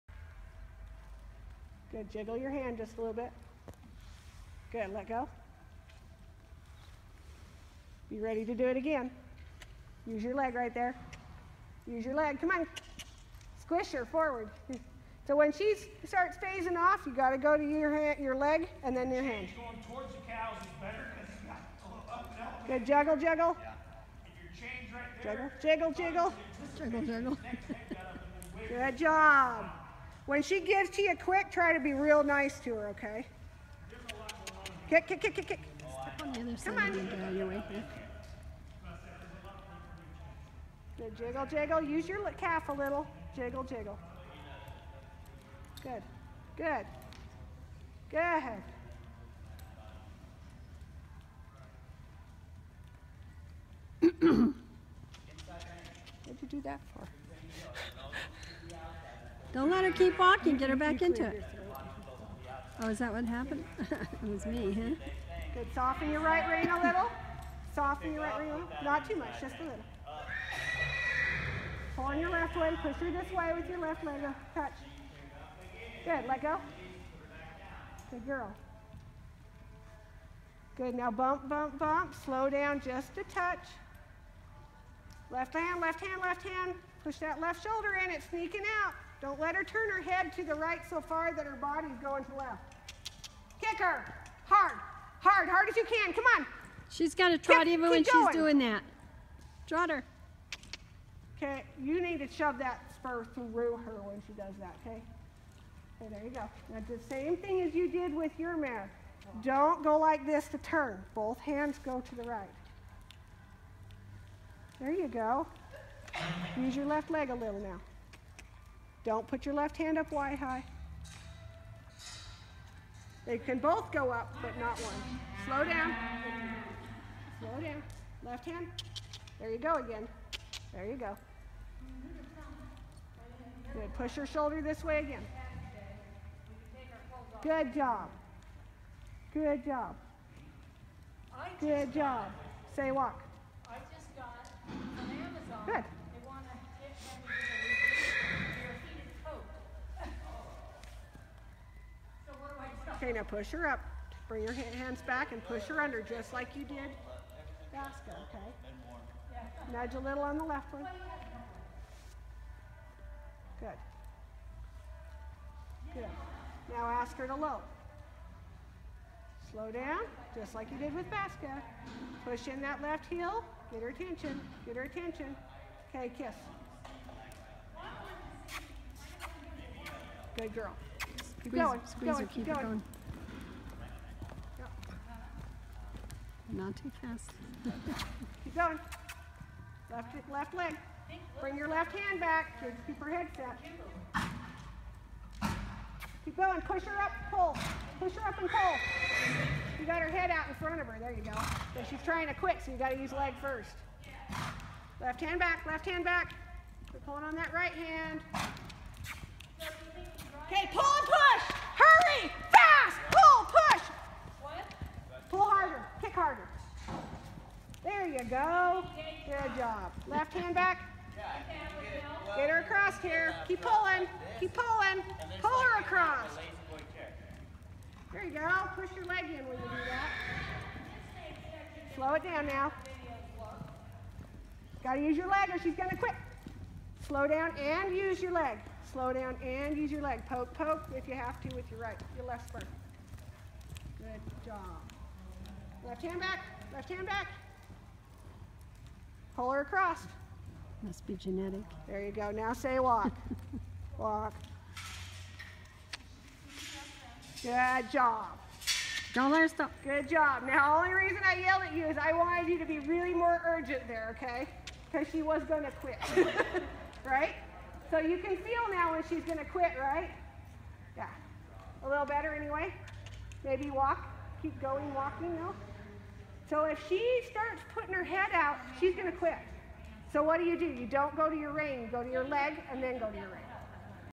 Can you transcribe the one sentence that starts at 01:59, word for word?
Don't put your left hand up wide high.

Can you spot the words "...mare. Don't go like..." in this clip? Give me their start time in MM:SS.
01:48.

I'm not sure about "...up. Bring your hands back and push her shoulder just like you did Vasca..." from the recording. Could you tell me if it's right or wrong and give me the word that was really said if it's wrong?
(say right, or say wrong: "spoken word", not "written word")
wrong: "under", not "shoulder".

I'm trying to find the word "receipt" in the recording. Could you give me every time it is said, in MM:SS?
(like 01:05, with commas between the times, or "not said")
not said.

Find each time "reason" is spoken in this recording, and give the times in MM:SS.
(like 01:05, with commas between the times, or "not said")
04:20.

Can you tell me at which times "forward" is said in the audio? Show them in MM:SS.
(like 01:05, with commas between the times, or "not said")
00:14.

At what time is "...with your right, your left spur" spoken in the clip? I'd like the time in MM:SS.
04:01.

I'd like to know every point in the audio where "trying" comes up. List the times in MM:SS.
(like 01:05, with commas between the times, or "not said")
03:22.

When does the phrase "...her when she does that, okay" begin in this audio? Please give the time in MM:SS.
01:43.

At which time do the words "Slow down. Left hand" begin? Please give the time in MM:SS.
02:07.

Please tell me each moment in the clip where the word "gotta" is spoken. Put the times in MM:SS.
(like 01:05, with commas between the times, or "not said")
00:17.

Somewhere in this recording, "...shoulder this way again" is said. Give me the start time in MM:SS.
02:14.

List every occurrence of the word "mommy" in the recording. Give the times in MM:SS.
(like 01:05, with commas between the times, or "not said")
not said.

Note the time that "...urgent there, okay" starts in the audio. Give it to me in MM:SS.
04:23.